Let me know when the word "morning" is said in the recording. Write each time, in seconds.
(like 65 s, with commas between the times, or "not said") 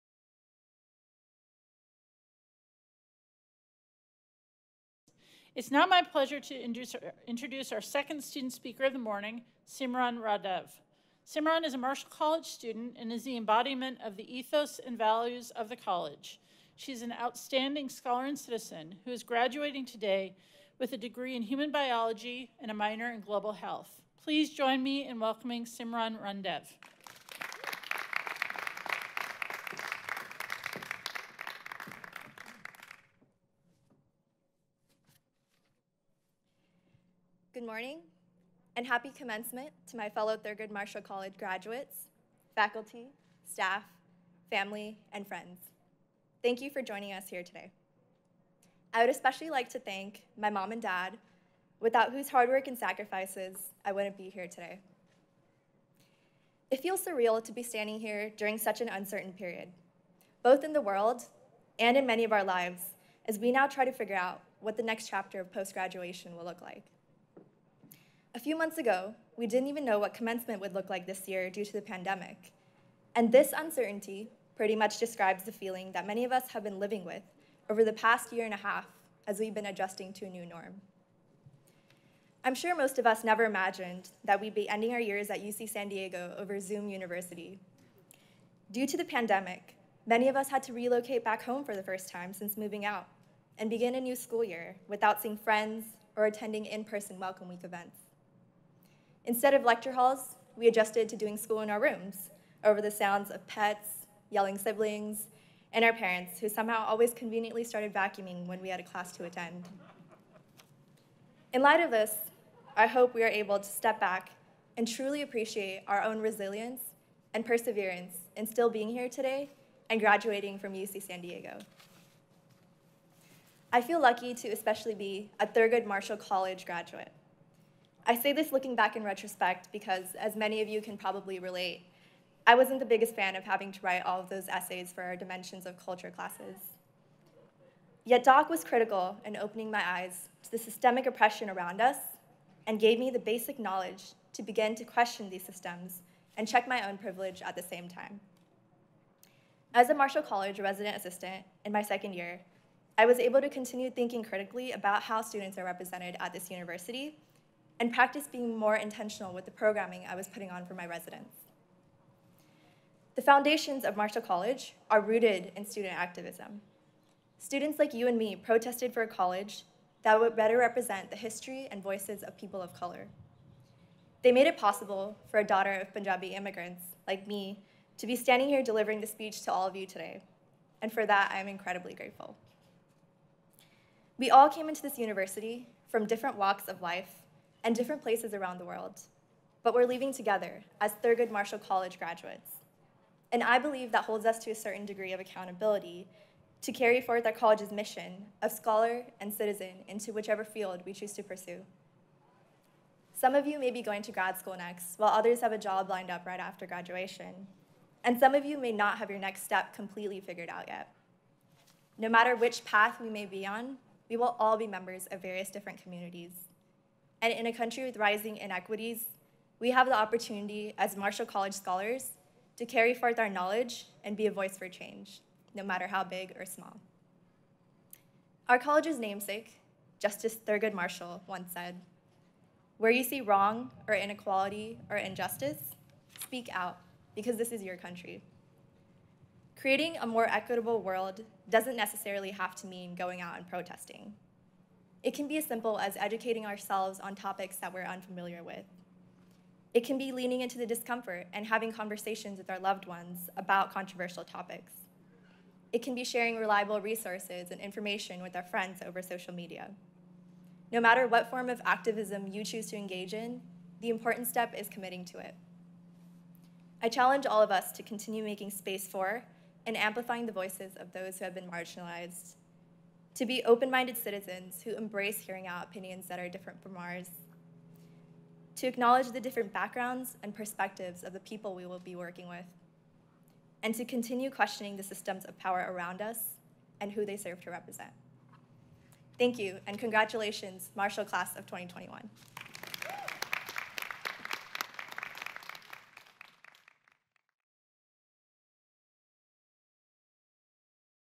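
8 s, 37 s.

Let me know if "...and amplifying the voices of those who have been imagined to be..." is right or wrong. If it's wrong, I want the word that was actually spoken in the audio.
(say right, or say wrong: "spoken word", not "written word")
wrong: "marginalized", not "imagined".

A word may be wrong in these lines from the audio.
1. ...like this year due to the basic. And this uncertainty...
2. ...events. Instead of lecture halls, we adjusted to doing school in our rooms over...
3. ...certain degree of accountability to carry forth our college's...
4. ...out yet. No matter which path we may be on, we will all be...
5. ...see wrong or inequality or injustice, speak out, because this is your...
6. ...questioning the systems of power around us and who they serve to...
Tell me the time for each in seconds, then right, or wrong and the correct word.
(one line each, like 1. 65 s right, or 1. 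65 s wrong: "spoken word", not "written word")
1. 70 s wrong: "pandemic", not "basic"
2. 97 s right
3. 194 s right
4. 210 s right
5. 233 s right
6. 284 s right.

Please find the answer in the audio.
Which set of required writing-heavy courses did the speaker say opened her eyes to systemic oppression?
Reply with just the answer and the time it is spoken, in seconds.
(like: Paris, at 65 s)
Dimensions of Culture, at 135 s.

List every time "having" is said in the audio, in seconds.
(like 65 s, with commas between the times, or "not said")
133 s, 251 s.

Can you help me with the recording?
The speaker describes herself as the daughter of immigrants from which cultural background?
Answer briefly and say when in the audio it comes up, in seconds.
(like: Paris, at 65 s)
Punjabi, at 175 s.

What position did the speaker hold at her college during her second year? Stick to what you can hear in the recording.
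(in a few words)
Resident assistant.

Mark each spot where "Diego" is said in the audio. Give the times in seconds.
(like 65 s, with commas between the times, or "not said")
85 s, 121 s.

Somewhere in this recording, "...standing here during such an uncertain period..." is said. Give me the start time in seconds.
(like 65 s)
57 s.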